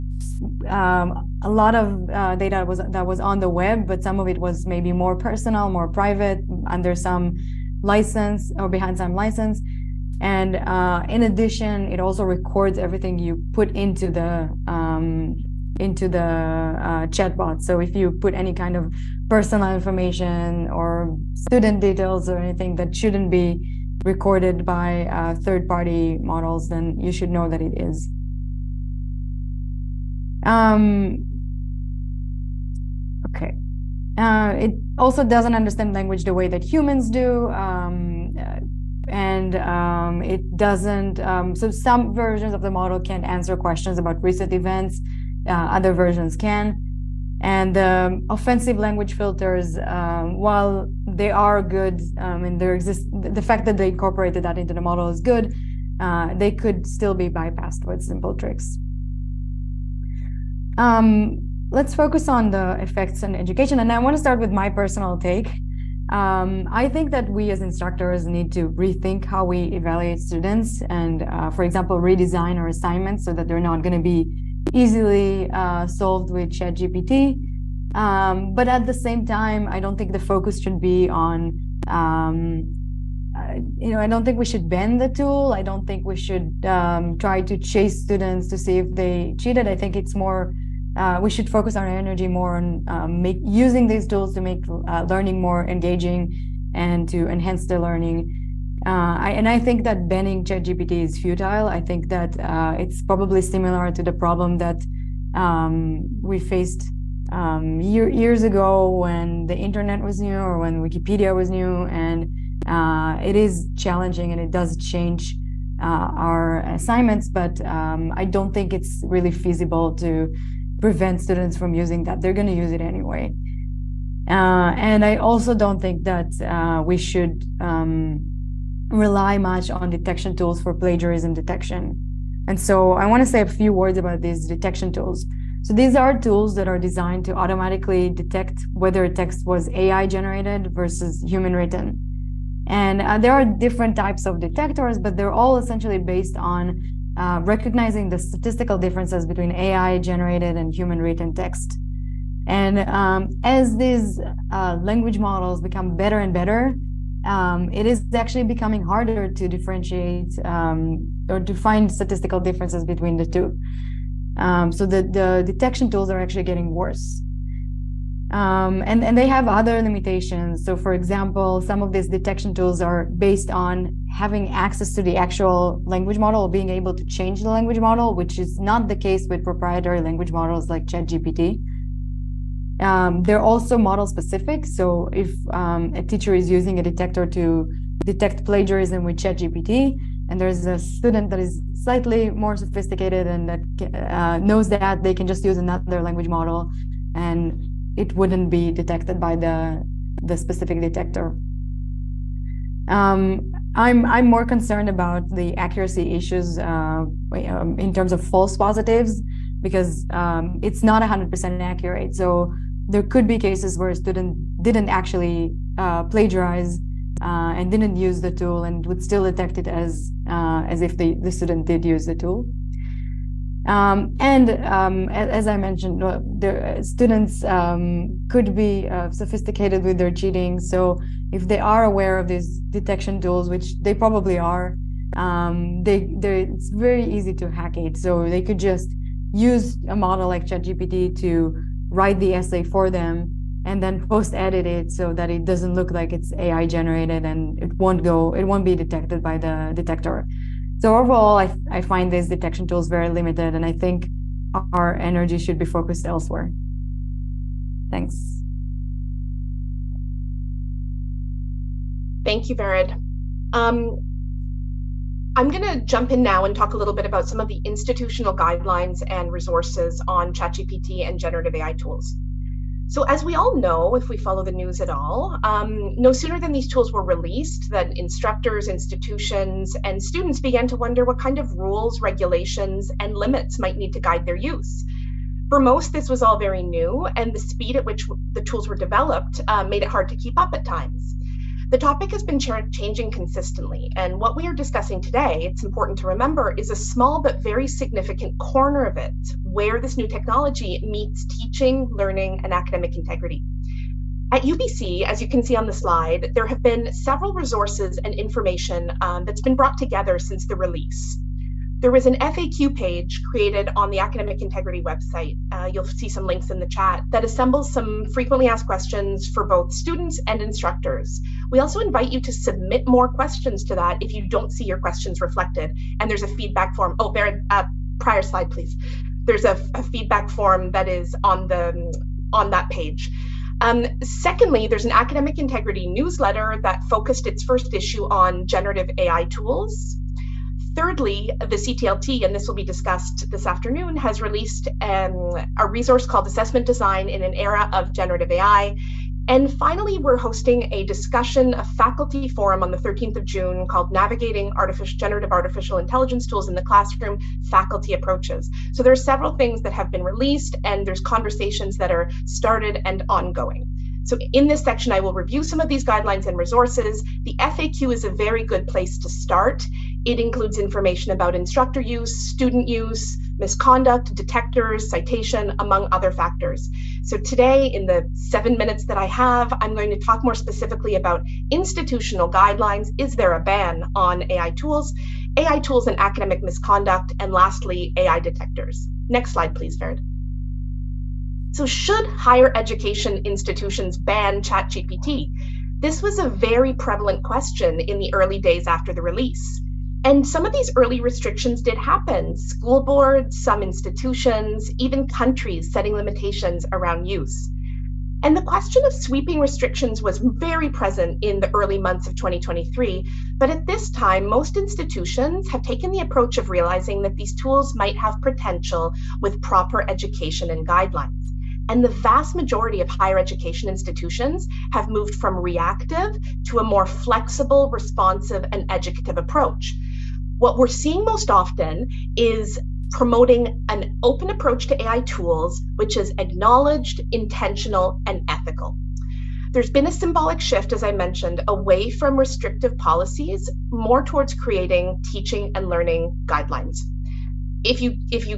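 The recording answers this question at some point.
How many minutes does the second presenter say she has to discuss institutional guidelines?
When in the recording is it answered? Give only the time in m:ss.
6:18.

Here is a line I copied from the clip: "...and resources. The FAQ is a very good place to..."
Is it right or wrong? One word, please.
right.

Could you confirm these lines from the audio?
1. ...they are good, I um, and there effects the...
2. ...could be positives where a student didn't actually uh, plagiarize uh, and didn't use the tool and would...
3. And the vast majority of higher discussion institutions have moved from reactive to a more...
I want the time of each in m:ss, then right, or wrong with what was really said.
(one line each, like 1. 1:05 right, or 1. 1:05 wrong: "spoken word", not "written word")
1. 0:51 wrong: "exists", not "effects"
2. 3:33 wrong: "cases", not "positives"
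3. 7:01 wrong: "education", not "discussion".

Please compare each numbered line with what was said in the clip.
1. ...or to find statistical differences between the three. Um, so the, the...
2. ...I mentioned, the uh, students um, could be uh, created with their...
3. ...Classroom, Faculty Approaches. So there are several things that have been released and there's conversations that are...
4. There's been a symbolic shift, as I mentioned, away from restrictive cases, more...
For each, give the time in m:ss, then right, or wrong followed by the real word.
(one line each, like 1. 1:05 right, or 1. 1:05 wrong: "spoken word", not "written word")
1. 2:41 wrong: "two", not "three"
2. 3:45 wrong: "sophisticated", not "created"
3. 5:56 right
4. 7:19 wrong: "policies", not "cases".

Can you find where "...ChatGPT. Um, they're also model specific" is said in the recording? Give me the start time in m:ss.
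3:00.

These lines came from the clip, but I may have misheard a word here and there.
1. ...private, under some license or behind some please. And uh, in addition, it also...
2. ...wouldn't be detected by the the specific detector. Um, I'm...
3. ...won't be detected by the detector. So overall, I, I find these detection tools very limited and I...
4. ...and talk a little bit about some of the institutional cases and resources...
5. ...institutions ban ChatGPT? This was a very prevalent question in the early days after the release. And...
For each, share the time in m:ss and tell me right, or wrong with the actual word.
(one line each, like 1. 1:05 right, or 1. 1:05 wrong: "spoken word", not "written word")
1. 0:05 wrong: "license", not "please"
2. 3:18 right
3. 4:08 right
4. 4:26 wrong: "guidelines", not "cases"
5. 6:33 right.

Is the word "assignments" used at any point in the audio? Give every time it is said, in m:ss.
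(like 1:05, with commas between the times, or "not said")
1:12, 1:56.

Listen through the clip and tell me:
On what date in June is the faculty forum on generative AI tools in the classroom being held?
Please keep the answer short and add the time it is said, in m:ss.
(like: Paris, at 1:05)
June 13, at 5:52.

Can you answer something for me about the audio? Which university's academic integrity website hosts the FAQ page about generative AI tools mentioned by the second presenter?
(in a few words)
UBC.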